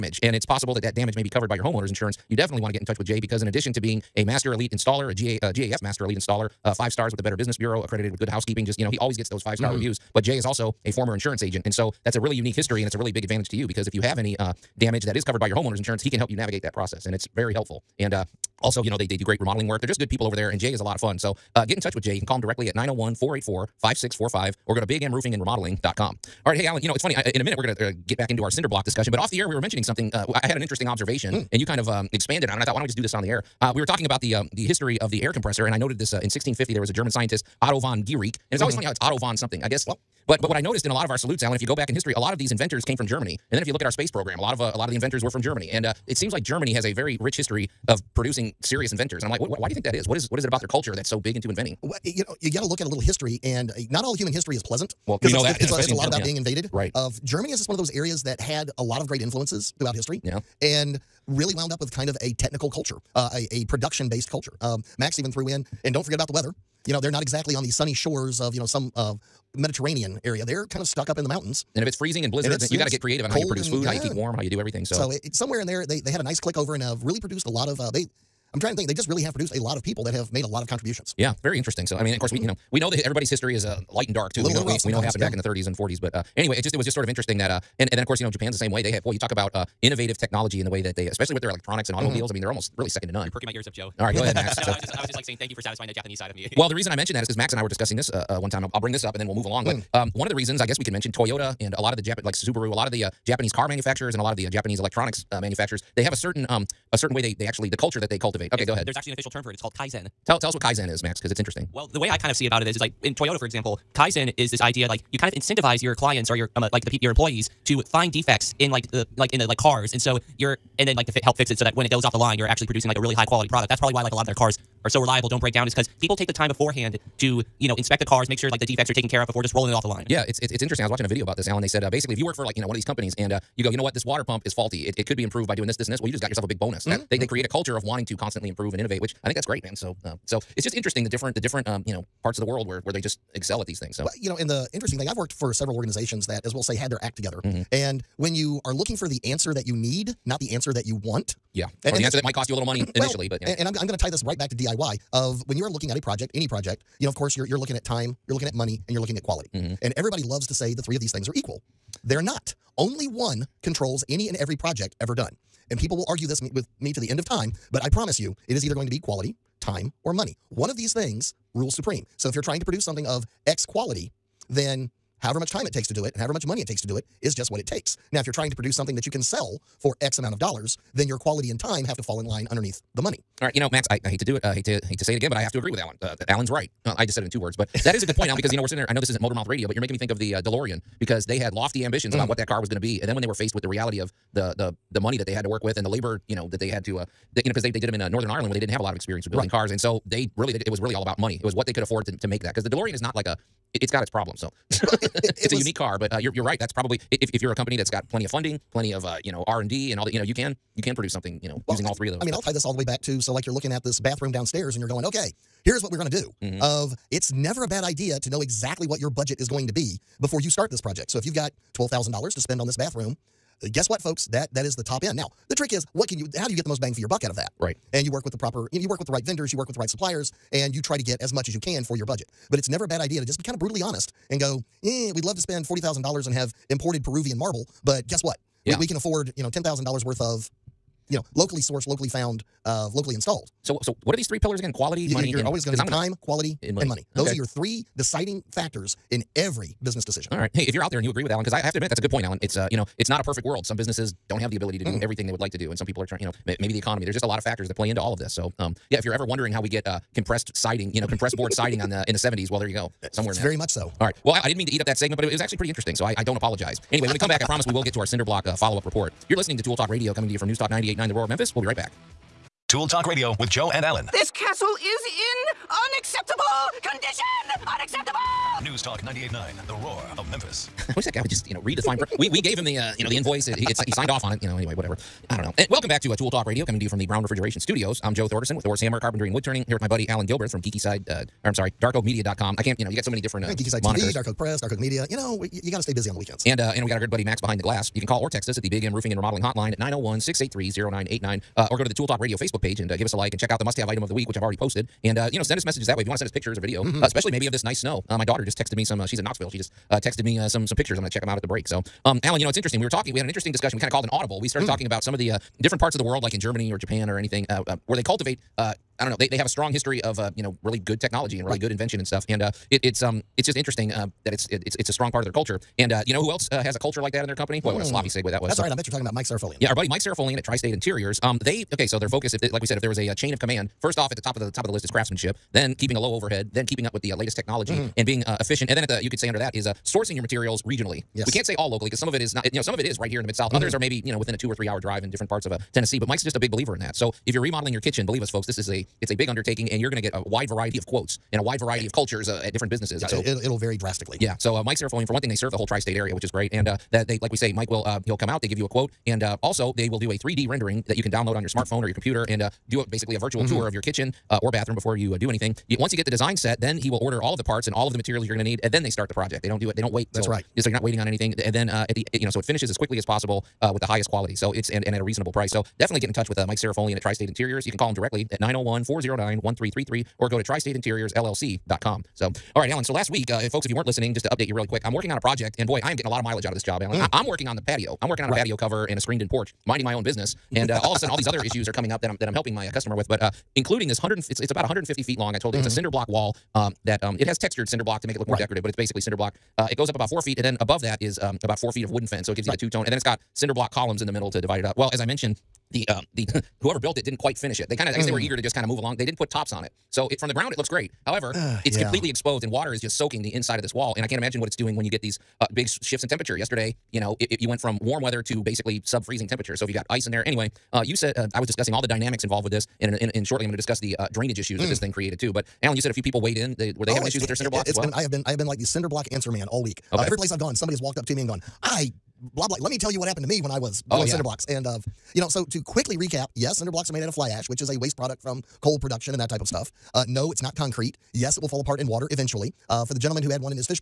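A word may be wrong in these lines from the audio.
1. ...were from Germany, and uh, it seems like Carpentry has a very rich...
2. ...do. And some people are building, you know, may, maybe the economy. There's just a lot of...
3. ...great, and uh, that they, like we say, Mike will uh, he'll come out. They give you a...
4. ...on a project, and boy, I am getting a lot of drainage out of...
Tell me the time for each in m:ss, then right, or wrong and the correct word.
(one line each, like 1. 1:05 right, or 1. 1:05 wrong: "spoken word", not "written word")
1. 0:45 wrong: "Germany", not "Carpentry"
2. 4:15 wrong: "trying", not "building"
3. 5:56 right
4. 6:25 wrong: "mileage", not "drainage".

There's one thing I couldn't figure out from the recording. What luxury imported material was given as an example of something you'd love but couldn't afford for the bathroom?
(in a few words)
Peruvian marble.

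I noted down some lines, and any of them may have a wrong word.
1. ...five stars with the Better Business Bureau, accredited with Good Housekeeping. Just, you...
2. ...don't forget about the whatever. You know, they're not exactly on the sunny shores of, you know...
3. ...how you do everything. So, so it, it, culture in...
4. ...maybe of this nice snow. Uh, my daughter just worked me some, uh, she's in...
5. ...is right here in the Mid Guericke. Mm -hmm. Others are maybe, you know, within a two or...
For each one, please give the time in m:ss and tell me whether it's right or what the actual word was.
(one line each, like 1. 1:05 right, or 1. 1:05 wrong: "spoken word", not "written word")
1. 0:06 right
2. 1:05 wrong: "weather", not "whatever"
3. 1:14 wrong: "somewhere", not "culture"
4. 5:07 wrong: "texted", not "worked"
5. 5:42 wrong: "South", not "Guericke".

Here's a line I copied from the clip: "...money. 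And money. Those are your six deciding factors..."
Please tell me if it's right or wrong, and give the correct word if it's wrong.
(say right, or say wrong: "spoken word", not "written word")
wrong: "three", not "six".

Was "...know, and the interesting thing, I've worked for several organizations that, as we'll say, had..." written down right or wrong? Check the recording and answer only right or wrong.
right.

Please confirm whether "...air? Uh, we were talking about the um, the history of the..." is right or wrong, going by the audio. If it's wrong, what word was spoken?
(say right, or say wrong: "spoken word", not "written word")
right.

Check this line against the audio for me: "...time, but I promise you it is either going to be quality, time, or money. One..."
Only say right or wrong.
right.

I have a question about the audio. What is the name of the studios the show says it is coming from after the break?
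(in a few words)
Brown Refrigeration Studios.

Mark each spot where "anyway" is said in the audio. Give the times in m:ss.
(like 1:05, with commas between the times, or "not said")
1:26, 4:26, 4:44, 7:00.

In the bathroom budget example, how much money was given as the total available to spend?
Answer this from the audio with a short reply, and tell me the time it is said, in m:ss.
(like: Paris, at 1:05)
$12,000, at 3:41.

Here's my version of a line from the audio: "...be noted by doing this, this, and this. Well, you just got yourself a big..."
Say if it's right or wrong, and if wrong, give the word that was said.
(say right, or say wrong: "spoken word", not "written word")
wrong: "improved", not "noted".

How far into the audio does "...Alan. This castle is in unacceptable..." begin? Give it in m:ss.
4:33.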